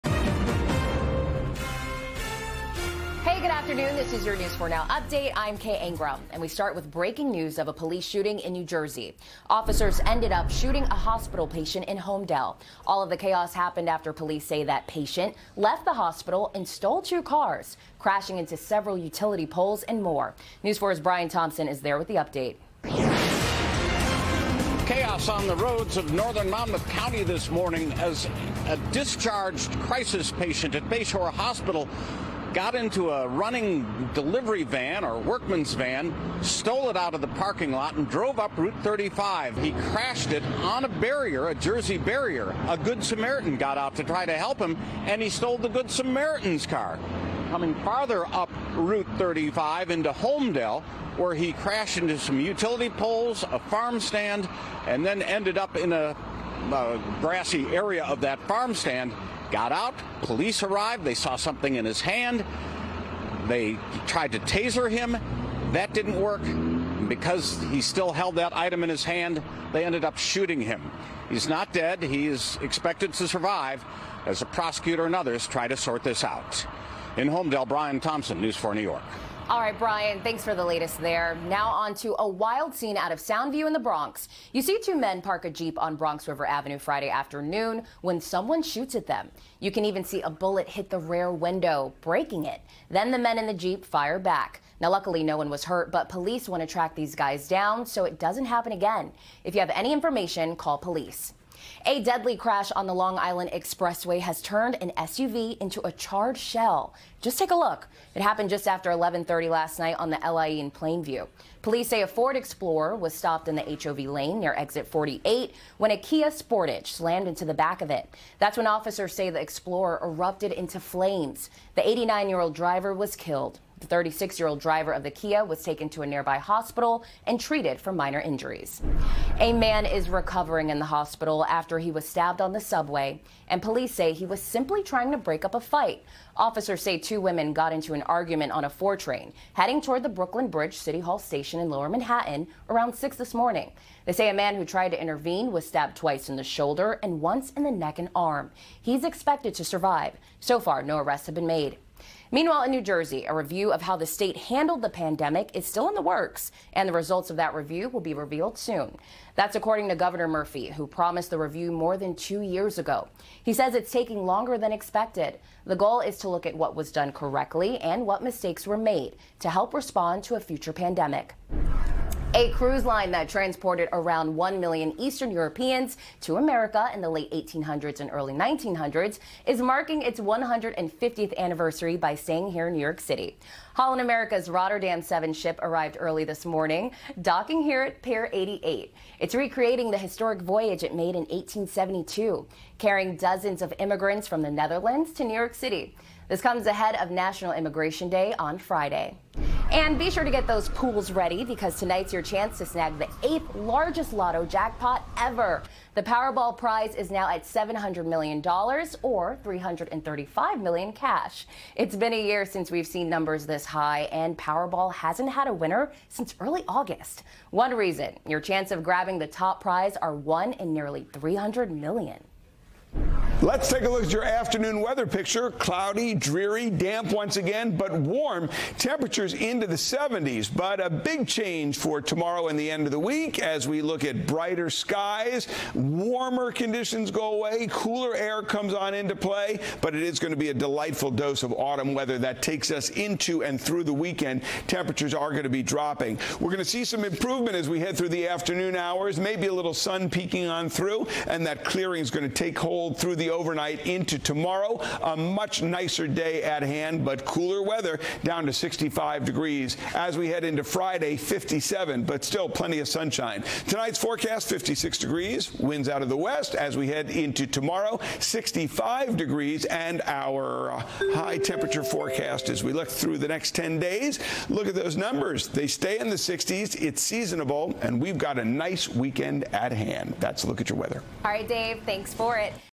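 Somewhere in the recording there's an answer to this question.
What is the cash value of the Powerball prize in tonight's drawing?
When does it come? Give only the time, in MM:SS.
03:29.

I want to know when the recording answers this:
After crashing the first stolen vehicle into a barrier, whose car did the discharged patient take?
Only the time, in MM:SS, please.
00:45.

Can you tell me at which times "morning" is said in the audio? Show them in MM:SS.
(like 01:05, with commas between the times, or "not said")
00:27, 02:23, 03:06.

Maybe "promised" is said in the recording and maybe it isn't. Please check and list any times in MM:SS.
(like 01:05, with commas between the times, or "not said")
02:40.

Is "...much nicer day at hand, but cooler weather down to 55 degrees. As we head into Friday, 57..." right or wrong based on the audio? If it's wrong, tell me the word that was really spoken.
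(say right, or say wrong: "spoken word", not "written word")
wrong: "65", not "55".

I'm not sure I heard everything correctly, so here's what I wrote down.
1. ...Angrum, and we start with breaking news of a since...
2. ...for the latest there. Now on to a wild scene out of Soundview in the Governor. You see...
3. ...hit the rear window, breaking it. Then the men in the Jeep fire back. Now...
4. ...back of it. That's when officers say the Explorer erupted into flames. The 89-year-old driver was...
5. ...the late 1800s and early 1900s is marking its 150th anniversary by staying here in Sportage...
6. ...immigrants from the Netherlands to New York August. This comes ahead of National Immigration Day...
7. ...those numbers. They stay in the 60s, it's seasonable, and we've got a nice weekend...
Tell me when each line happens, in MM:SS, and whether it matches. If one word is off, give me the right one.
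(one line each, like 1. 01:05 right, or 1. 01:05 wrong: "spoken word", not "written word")
1. 00:05 wrong: "police", not "since"
2. 01:20 wrong: "Bronx", not "Governor"
3. 01:30 right
4. 01:57 right
5. 02:56 wrong: "New", not "Sportage"
6. 03:13 wrong: "City", not "August"
7. 04:34 right.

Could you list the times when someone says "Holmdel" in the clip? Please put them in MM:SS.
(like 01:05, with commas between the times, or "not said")
00:11, 00:50, 01:17.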